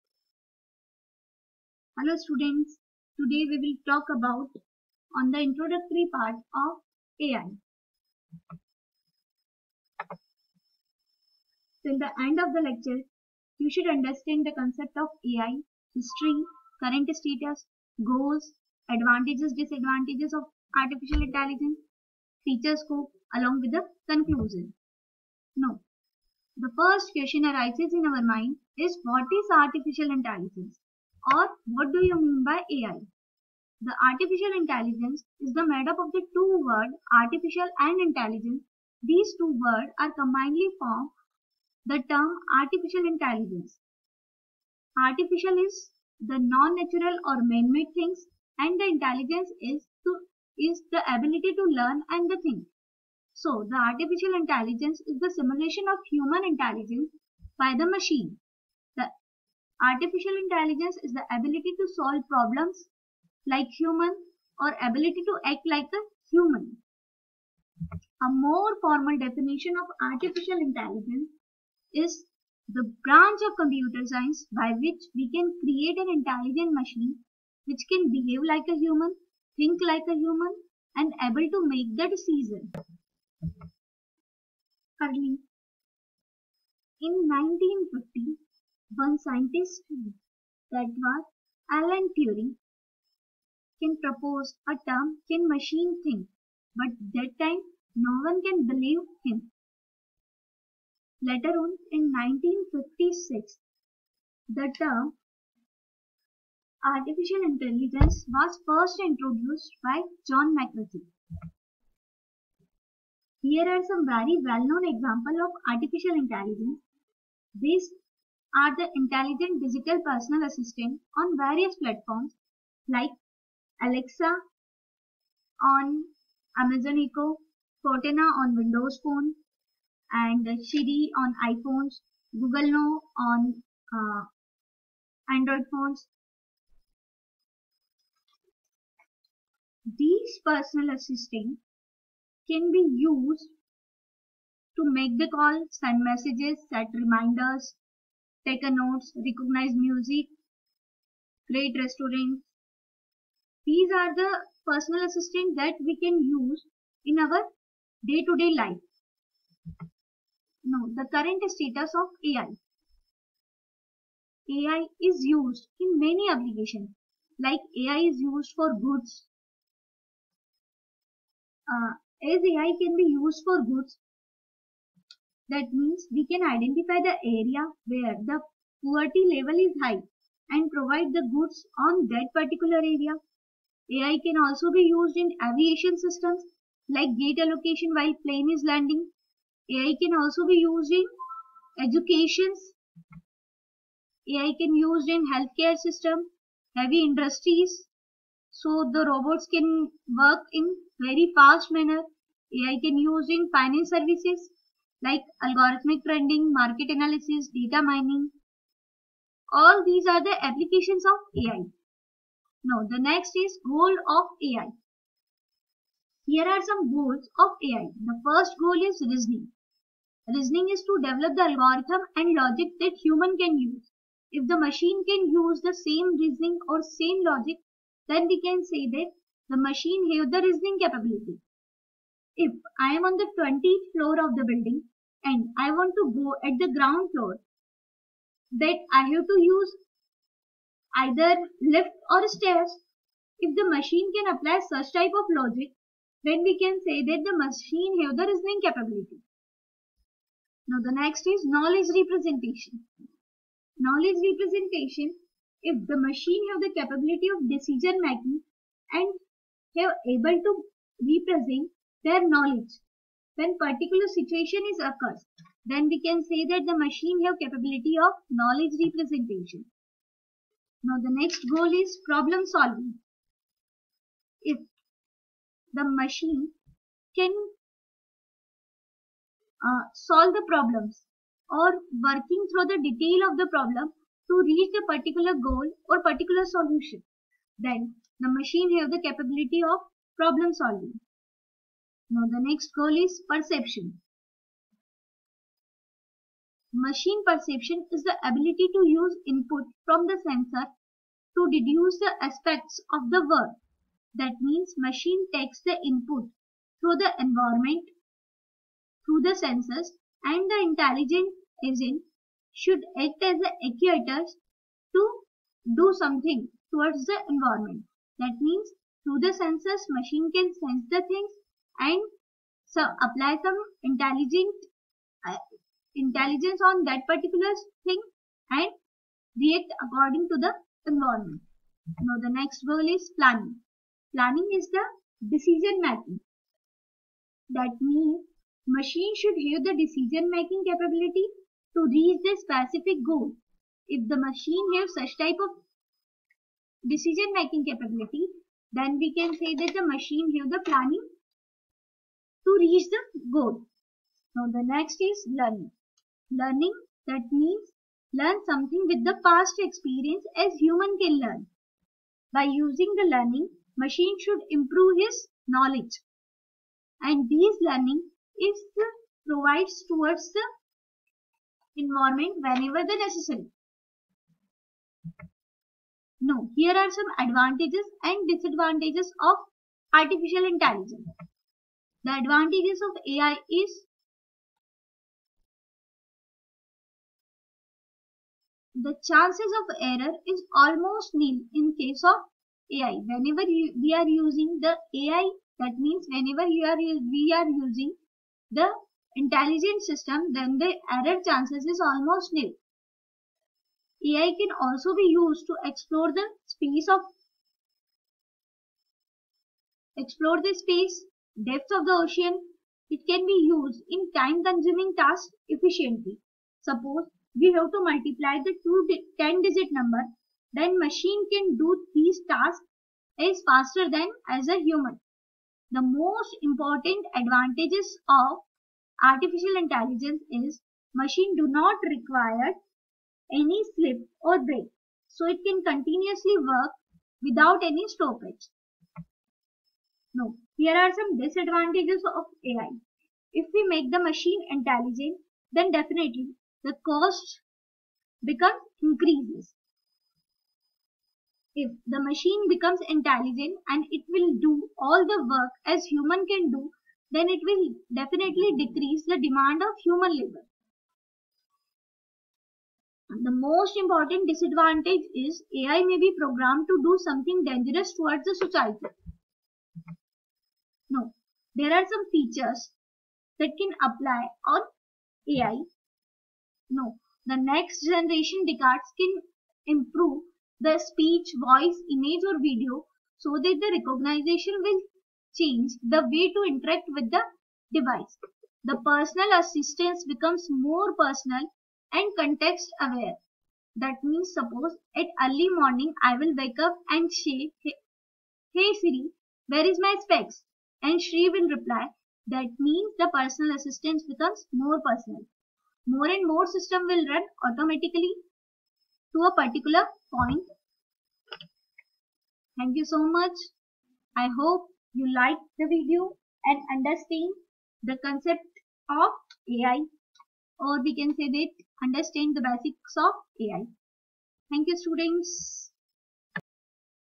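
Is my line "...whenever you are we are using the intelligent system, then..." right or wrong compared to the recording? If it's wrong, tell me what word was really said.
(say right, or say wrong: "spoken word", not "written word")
right.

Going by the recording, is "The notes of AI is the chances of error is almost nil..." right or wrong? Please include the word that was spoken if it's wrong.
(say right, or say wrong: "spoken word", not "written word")
wrong: "advantages", not "notes".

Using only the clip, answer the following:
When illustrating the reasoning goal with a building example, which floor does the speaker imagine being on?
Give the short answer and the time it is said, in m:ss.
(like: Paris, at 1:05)
20th floor, at 3:53.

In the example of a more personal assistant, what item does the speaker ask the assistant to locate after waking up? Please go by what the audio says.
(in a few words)
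specs.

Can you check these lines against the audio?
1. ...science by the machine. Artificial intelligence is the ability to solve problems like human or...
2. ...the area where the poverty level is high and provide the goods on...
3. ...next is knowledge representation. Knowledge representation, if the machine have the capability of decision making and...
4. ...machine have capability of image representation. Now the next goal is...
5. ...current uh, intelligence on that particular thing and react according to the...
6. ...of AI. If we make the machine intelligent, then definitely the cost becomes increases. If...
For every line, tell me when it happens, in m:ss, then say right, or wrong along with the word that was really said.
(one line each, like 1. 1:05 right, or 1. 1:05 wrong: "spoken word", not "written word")
1. 0:56 wrong: "intelligence", not "science"
2. 2:57 right
3. 4:10 right
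4. 4:26 wrong: "knowledge", not "image"
5. 5:23 wrong: "intelligent", not "current"
6. 7:22 right.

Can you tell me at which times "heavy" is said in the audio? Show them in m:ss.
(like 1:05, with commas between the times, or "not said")
3:16.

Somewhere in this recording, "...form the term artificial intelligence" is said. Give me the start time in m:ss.
0:40.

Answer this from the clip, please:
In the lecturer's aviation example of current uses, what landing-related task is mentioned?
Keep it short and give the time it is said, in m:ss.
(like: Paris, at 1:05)
gate allocation, at 3:07.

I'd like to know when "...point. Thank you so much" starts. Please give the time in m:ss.
8:30.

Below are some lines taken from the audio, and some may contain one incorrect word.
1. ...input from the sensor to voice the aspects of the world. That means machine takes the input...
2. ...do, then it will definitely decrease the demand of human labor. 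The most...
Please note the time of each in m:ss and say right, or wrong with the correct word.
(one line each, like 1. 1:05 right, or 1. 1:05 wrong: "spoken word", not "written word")
1. 4:59 wrong: "deduce", not "voice"
2. 7:36 right.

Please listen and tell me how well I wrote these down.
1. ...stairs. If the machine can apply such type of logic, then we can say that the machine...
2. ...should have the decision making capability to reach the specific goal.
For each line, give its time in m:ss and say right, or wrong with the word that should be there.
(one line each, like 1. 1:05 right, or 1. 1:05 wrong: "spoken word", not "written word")
1. 4:02 right
2. 5:39 right.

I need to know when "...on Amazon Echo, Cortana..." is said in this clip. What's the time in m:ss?
2:05.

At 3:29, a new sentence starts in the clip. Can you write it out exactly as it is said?
All these are the applications of AI.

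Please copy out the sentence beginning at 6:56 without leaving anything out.
Suppose we have to multiply the two 10-digit number, then machine can do these tasks as faster than as a human.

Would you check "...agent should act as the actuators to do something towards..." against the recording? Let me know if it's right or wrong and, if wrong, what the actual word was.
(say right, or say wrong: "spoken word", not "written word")
right.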